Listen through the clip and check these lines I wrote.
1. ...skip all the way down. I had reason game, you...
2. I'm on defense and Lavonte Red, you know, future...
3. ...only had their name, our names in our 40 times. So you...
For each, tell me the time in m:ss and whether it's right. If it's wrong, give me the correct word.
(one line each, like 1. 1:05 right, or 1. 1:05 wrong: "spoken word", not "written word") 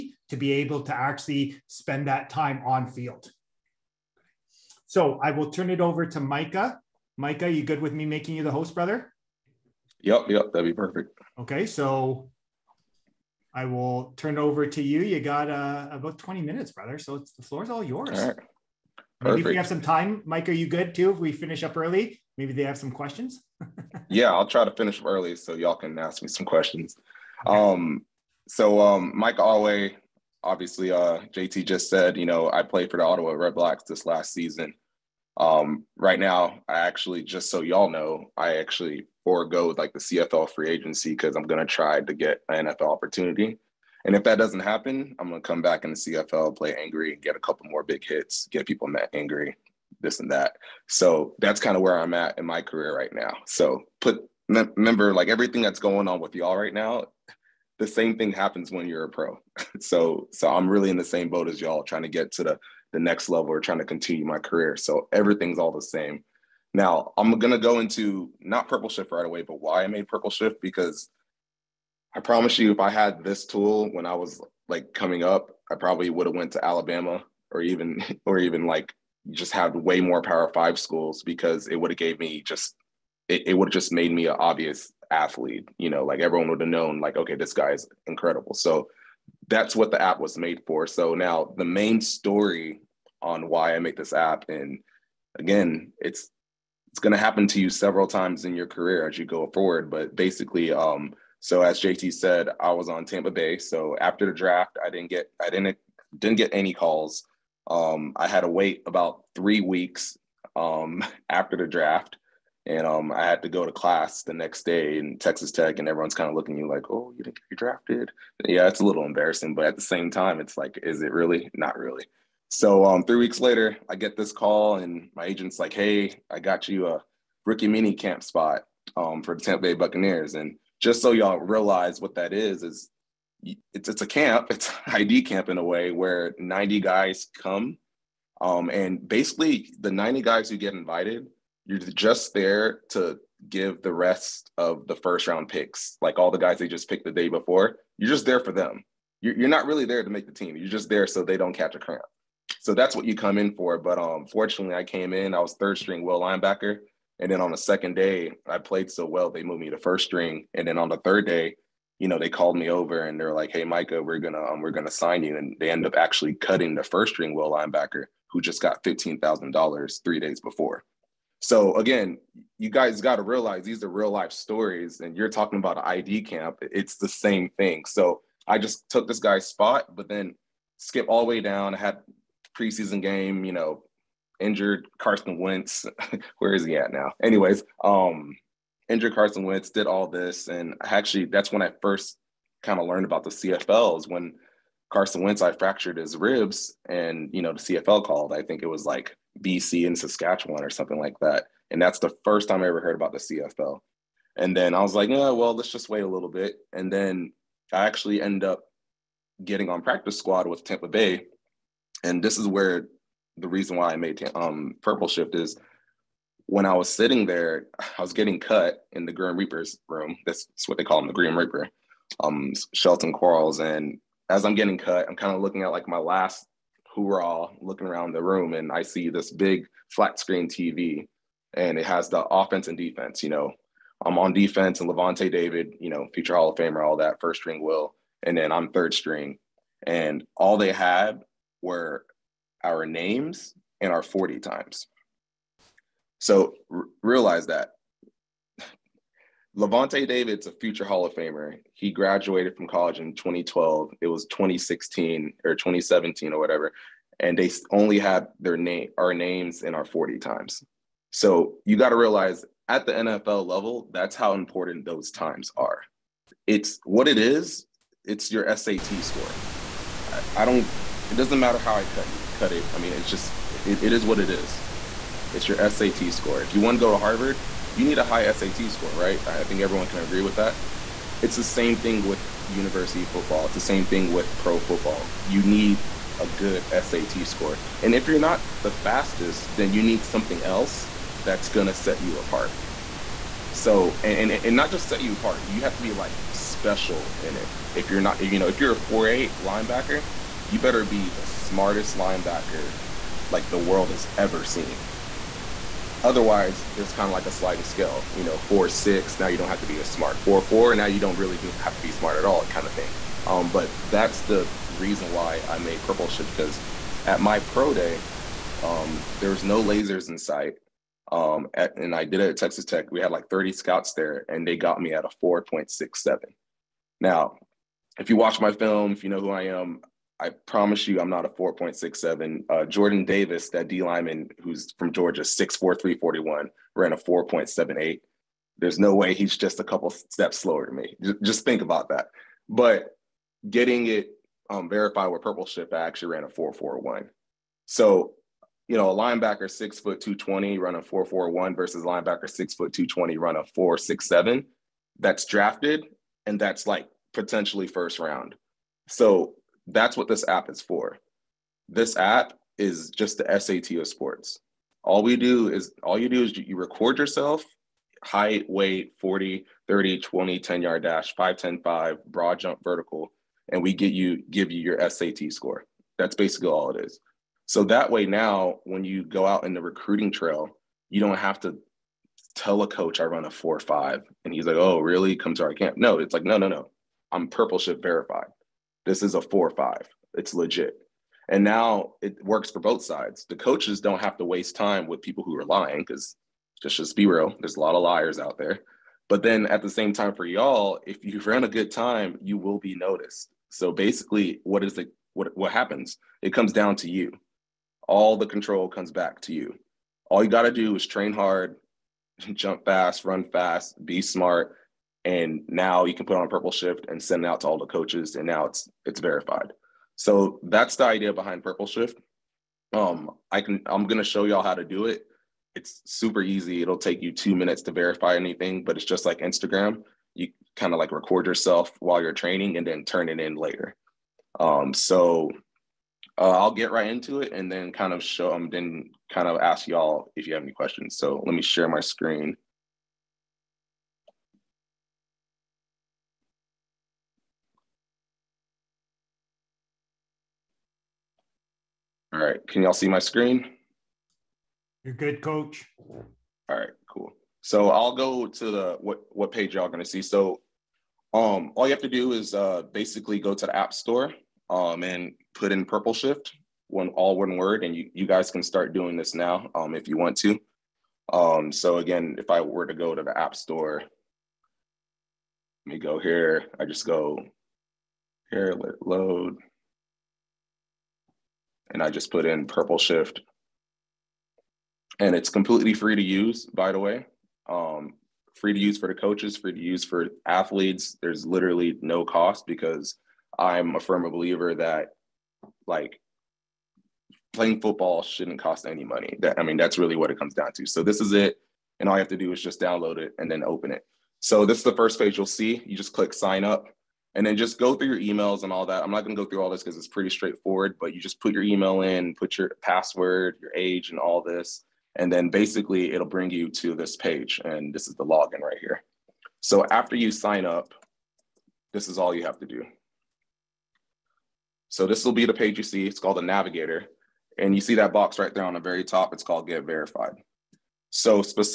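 1. 3:00 wrong: "preseason", not "reason"
2. 3:54 wrong: "David", not "Red"
3. 4:17 right.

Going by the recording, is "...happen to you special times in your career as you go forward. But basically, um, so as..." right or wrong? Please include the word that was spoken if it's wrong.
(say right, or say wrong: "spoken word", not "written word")
wrong: "several", not "special".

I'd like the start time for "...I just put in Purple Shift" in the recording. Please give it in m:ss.
8:01.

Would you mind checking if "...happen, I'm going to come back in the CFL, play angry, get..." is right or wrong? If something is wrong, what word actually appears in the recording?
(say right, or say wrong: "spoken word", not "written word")
right.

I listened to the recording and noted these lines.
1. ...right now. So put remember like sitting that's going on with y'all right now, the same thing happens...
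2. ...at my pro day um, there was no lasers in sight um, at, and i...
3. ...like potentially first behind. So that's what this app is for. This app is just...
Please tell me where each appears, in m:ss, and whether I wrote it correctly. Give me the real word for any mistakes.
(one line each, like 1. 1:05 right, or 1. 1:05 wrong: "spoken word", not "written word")
1. 0:52 wrong: "everything", not "sitting"
2. 5:17 right
3. 5:56 wrong: "round", not "behind".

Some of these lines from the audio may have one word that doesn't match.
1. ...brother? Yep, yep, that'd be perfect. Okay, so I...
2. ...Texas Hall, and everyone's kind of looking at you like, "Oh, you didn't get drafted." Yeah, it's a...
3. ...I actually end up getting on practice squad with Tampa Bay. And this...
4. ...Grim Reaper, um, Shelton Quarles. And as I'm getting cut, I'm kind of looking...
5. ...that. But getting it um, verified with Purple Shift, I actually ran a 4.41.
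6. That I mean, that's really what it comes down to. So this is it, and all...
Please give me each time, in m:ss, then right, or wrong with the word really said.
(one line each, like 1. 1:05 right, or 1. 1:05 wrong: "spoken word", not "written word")
1. 0:08 right
2. 1:55 wrong: "Tech", not "Hall"
3. 3:27 right
4. 3:41 right
5. 5:41 right
6. 8:19 right.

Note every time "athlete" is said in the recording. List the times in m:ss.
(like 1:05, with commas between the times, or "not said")
1:25, 8:10.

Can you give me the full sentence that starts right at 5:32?
Uh, Jordan Davis, that D lineman who's from Georgia, 6'4, 341, ran a 4.78.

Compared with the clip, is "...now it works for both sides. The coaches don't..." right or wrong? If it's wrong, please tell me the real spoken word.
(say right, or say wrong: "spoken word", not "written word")
right.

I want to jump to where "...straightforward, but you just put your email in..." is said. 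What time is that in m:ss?
8:30.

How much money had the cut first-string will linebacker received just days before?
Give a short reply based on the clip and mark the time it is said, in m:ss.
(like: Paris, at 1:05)
$15,000, at 2:48.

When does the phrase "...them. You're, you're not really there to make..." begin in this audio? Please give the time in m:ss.
2:28.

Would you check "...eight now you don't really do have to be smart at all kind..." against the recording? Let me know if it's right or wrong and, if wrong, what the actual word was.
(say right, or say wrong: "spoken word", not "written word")
wrong: "four", not "eight".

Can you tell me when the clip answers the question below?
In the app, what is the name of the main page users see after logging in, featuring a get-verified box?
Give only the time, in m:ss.
8:46.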